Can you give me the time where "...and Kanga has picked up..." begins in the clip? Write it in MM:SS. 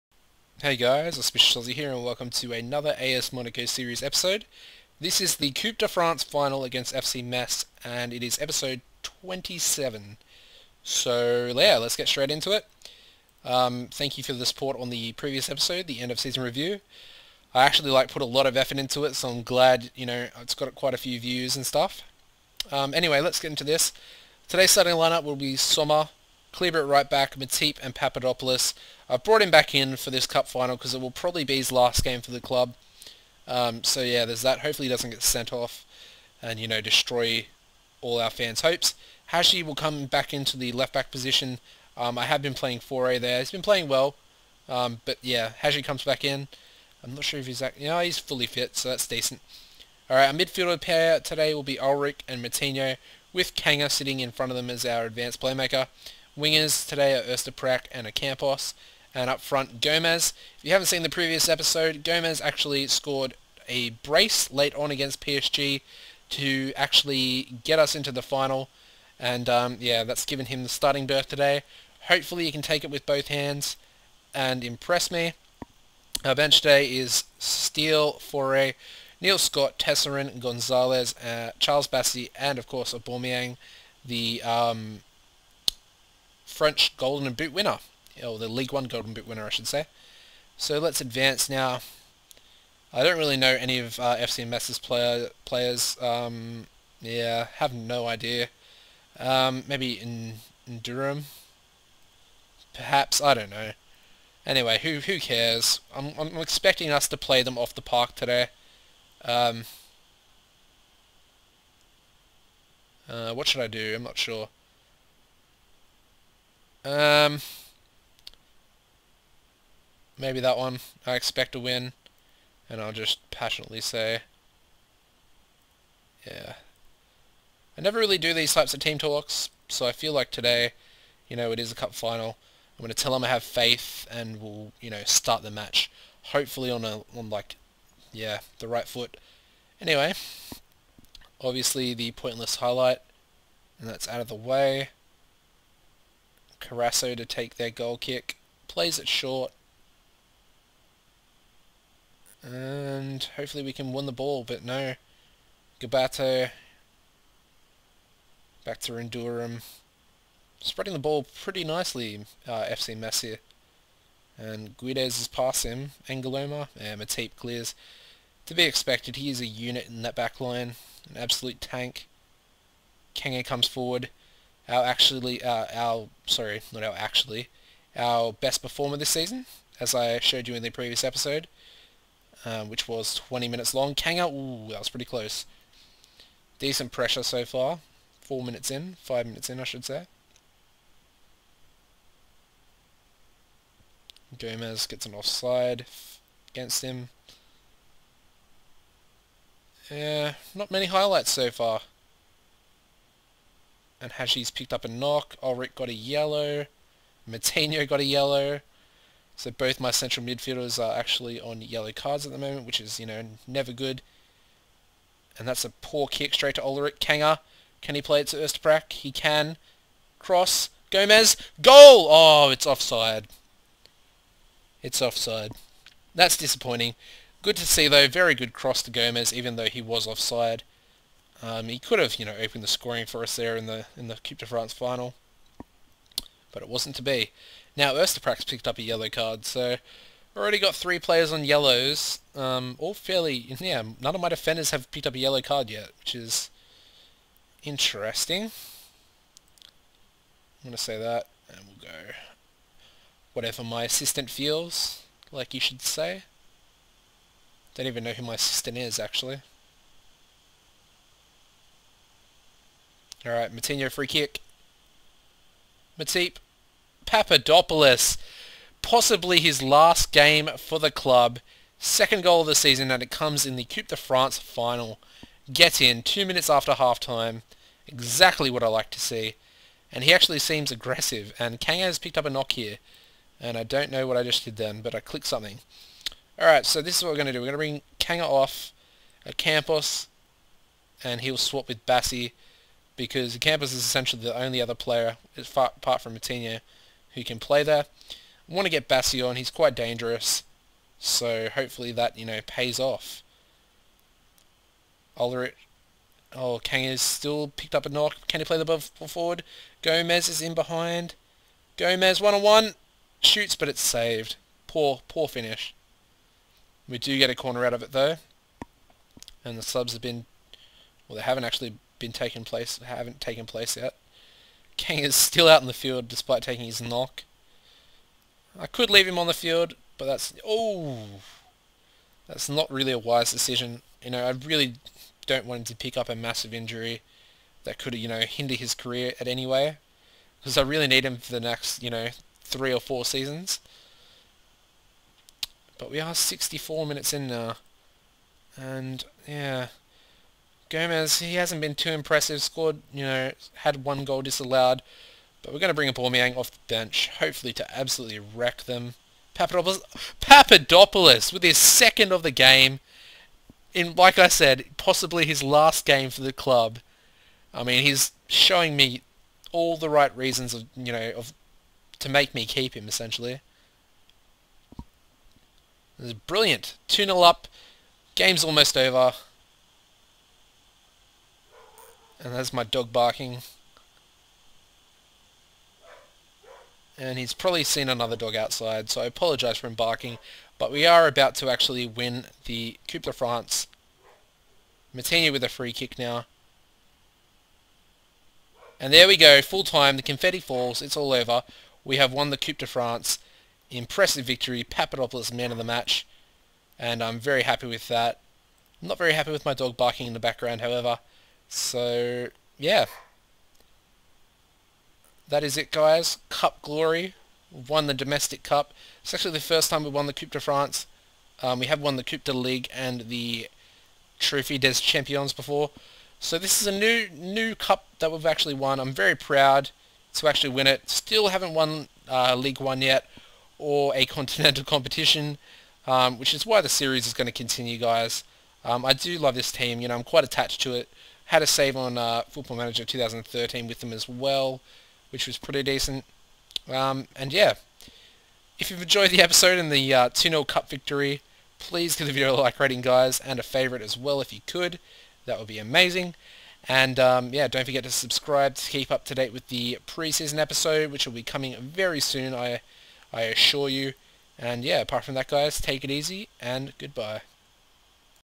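04:41.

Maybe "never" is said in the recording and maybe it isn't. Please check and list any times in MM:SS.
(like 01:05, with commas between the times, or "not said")
02:07, 03:33.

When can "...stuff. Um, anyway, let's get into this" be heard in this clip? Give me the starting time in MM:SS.
00:21.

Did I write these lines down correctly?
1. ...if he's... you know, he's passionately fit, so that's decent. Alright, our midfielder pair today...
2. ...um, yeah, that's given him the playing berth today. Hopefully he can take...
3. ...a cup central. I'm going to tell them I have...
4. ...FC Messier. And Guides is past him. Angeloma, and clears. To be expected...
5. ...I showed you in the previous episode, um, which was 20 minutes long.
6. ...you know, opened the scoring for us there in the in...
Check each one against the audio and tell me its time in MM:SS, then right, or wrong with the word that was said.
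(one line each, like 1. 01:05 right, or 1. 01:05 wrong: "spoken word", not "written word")
1. 00:47 wrong: "fully", not "passionately"
2. 01:09 wrong: "starting", not "playing"
3. 02:11 wrong: "final", not "central"
4. 02:42 right
5. 02:59 right
6. 03:52 right.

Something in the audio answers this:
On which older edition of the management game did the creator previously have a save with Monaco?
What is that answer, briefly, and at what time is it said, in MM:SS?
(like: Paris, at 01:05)
Football Manager 2013, at 07:22.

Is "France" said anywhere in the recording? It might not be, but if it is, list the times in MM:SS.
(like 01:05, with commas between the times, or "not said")
00:05, 03:54, 04:33, 06:33, 06:42, 07:00.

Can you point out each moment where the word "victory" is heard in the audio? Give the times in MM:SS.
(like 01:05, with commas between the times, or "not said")
06:44, 07:30.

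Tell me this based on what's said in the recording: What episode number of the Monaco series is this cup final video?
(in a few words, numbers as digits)
27.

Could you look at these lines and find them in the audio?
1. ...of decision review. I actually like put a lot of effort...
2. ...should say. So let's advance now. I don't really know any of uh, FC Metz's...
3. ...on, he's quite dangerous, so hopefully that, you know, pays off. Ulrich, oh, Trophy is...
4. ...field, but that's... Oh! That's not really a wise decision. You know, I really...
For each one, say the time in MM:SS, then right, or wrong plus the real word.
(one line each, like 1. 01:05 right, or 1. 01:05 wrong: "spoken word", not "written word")
1. 00:16 wrong: "season", not "decision"
2. 01:29 right
3. 04:59 wrong: "Kang", not "Trophy"
4. 05:29 right.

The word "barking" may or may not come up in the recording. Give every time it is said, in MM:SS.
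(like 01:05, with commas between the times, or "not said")
06:22, 06:29, 06:49.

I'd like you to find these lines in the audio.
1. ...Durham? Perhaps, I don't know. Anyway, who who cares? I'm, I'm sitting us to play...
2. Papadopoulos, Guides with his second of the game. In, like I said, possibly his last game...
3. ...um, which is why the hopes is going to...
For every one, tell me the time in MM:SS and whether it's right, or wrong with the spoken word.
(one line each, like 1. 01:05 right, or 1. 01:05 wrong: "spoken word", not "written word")
1. 01:40 wrong: "expecting", not "sitting"
2. 05:59 wrong: "Papadopoulos", not "Guides"
3. 07:15 wrong: "series", not "hopes".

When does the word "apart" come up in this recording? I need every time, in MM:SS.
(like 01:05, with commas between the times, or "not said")
04:55, 07:44.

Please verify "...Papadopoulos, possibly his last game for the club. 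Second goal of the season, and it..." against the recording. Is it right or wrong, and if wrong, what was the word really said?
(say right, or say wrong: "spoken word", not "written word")
right.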